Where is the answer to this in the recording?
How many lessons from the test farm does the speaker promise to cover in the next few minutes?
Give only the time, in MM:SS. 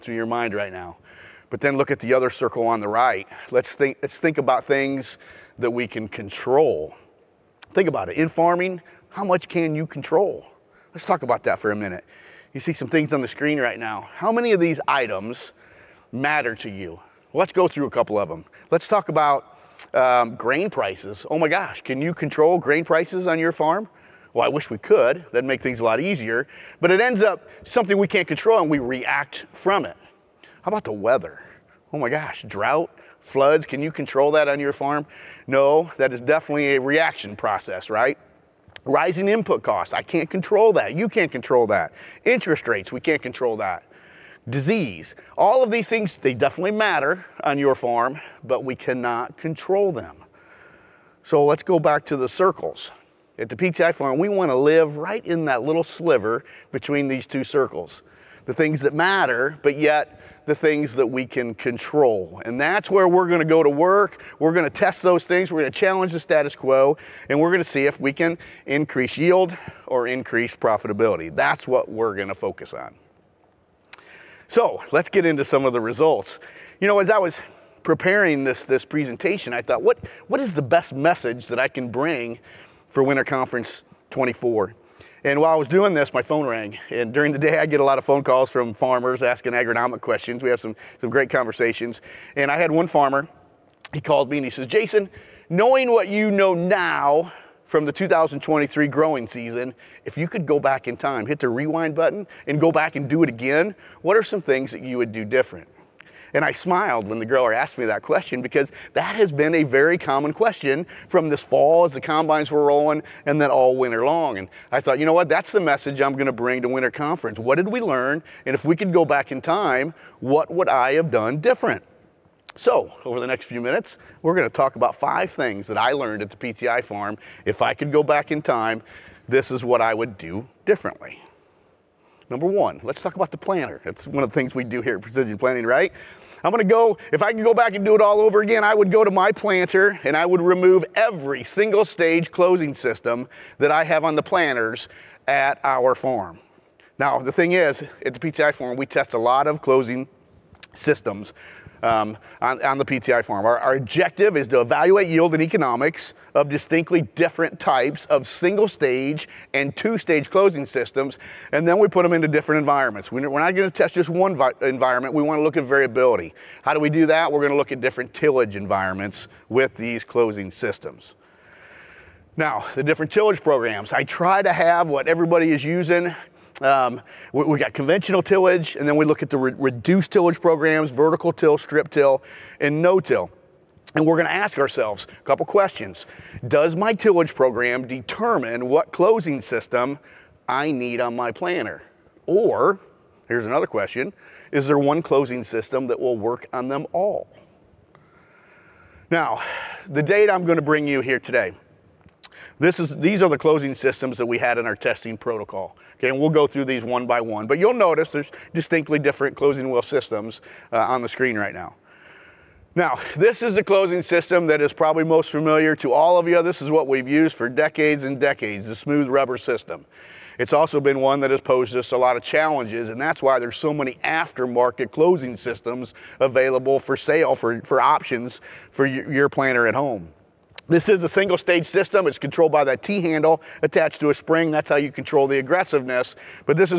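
02:04.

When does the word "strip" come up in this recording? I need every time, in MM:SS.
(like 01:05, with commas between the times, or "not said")
03:01.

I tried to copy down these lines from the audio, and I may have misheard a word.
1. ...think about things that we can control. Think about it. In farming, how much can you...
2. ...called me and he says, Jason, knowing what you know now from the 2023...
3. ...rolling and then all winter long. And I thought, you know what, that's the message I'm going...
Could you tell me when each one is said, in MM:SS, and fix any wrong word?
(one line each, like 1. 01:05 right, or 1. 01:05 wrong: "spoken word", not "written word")
1. 00:04 right
2. 01:33 right
3. 01:52 right.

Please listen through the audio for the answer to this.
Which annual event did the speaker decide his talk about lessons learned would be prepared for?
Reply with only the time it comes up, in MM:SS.
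01:23.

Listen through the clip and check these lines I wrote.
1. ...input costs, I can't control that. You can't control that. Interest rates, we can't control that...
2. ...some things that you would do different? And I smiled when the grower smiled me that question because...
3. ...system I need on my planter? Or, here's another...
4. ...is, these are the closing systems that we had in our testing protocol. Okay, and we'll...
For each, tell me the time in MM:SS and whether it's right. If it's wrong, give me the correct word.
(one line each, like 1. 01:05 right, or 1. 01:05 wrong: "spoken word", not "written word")
1. 00:39 right
2. 01:44 wrong: "asked", not "smiled"
3. 03:09 right
4. 03:22 right.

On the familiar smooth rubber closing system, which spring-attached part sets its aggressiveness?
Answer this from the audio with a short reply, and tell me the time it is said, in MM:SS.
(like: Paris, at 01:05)
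T handle, at 03:52.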